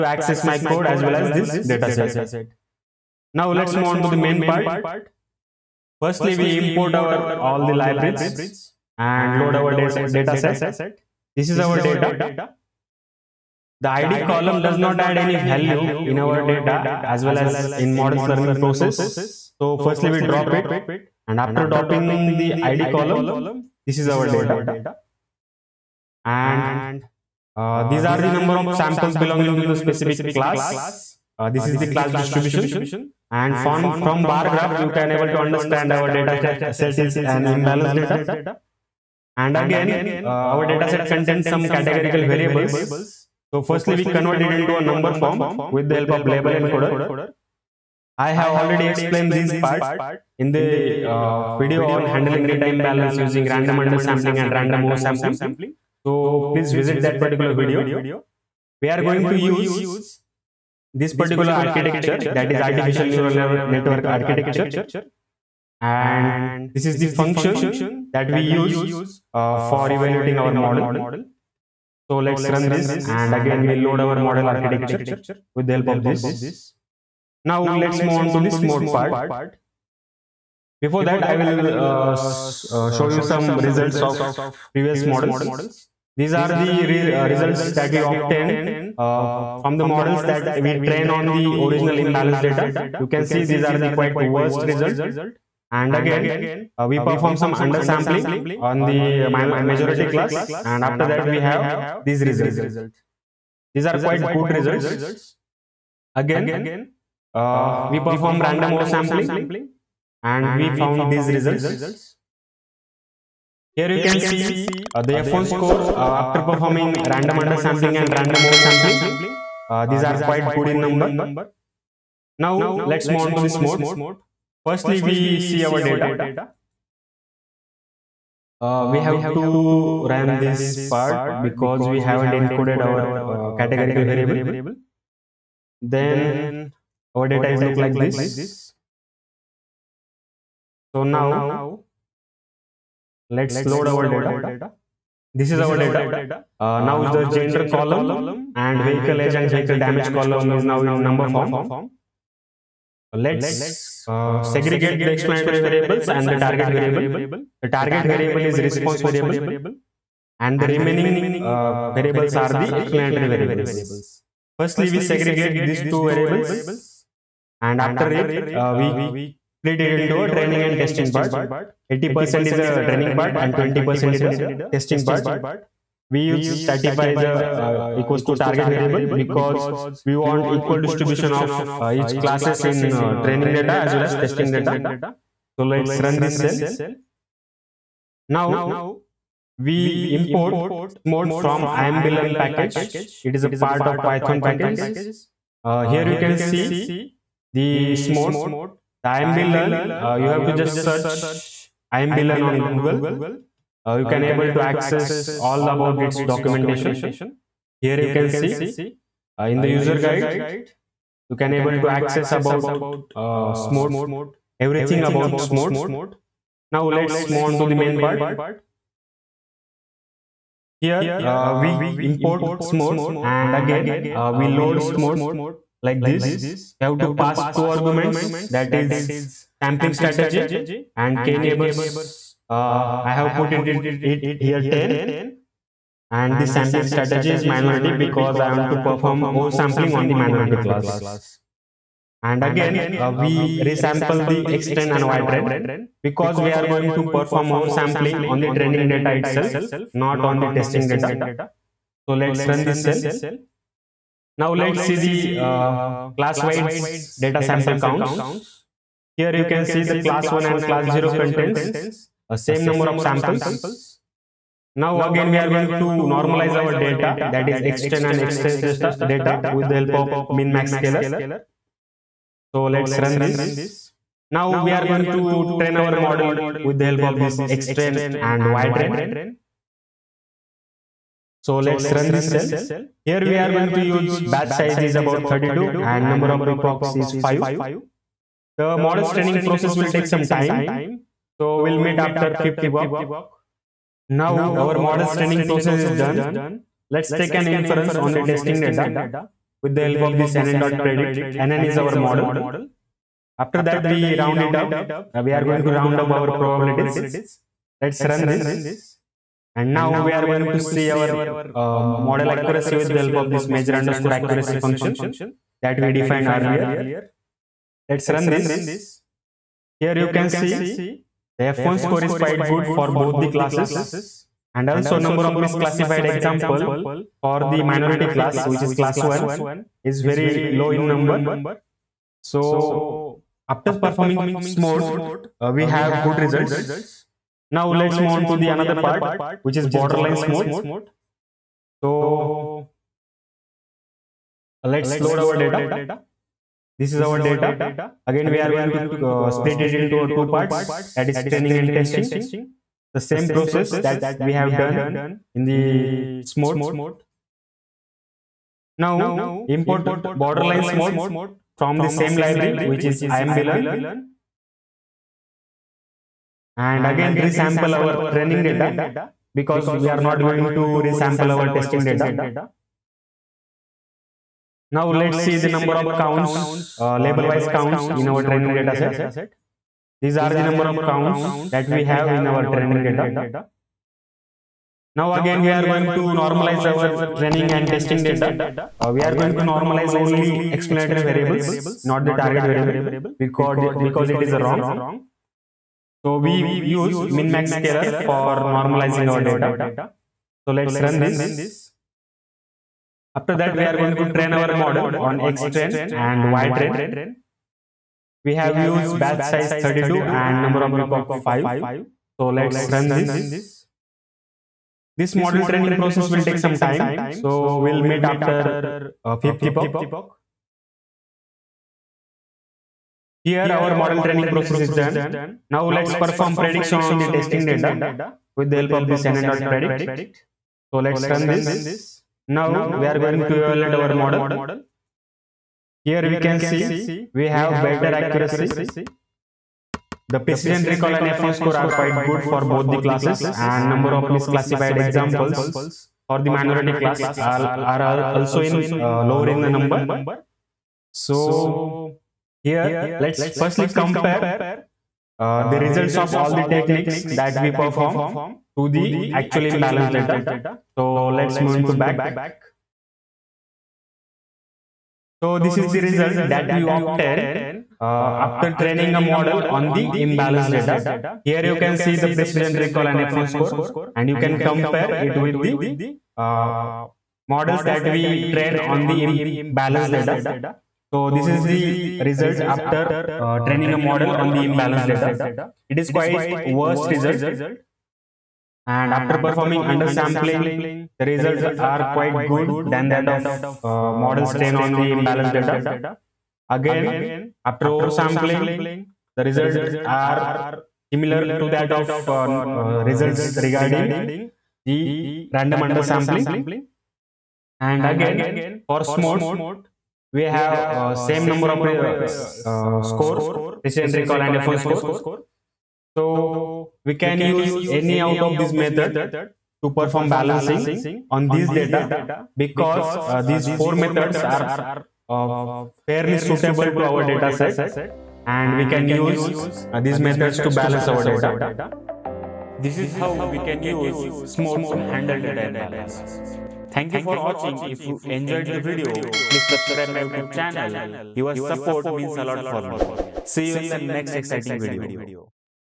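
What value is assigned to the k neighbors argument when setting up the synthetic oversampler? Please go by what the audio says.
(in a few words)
10.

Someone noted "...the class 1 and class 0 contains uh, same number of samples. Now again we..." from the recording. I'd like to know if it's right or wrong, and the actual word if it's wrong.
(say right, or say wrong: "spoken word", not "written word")
right.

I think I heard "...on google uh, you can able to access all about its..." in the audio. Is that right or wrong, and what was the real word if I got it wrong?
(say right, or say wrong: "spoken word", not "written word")
right.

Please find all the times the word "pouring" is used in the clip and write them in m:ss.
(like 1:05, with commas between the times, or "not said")
not said.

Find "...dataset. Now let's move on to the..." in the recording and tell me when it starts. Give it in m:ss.
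0:01.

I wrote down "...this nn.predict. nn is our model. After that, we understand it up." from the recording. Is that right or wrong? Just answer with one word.
wrong.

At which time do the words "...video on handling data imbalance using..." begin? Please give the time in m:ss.
0:51.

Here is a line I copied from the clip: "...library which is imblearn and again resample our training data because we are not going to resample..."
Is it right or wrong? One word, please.
right.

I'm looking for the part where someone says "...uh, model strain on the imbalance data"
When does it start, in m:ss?
8:13.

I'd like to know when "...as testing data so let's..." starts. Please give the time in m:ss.
3:04.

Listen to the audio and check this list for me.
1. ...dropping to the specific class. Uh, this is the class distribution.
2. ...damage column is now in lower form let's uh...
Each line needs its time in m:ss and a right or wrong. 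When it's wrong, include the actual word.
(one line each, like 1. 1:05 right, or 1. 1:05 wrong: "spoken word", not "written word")
1. 0:29 wrong: "belonging", not "dropping"
2. 2:29 wrong: "number", not "lower".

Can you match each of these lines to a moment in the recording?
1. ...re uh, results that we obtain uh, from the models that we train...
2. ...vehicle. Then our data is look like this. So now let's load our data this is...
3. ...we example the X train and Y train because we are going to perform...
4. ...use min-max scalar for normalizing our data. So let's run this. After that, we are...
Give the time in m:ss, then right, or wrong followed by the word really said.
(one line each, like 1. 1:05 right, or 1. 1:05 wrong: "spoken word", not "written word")
1. 1:26 right
2. 2:14 wrong: "variable", not "vehicle"
3. 4:03 wrong: "resample", not "example"
4. 6:36 right.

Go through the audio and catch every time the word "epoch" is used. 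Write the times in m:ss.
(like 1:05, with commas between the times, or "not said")
4:46, 4:52, 6:50, 6:59.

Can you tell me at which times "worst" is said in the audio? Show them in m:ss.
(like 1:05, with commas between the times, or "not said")
1:34, 8:06.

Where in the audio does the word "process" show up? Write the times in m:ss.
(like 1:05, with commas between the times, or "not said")
0:18, 4:49, 4:55, 5:53, 6:55, 7:04.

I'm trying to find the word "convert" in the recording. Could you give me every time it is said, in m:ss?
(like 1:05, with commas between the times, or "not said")
0:44.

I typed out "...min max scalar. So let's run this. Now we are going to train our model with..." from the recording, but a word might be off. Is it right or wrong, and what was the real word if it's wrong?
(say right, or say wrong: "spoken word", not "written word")
right.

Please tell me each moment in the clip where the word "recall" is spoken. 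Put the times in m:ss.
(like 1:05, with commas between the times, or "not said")
7:20, 7:52, 8:33.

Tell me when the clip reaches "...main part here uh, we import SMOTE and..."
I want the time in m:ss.
3:37.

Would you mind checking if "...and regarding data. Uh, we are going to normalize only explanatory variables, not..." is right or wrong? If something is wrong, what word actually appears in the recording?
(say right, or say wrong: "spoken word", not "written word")
wrong: "testing", not "regarding".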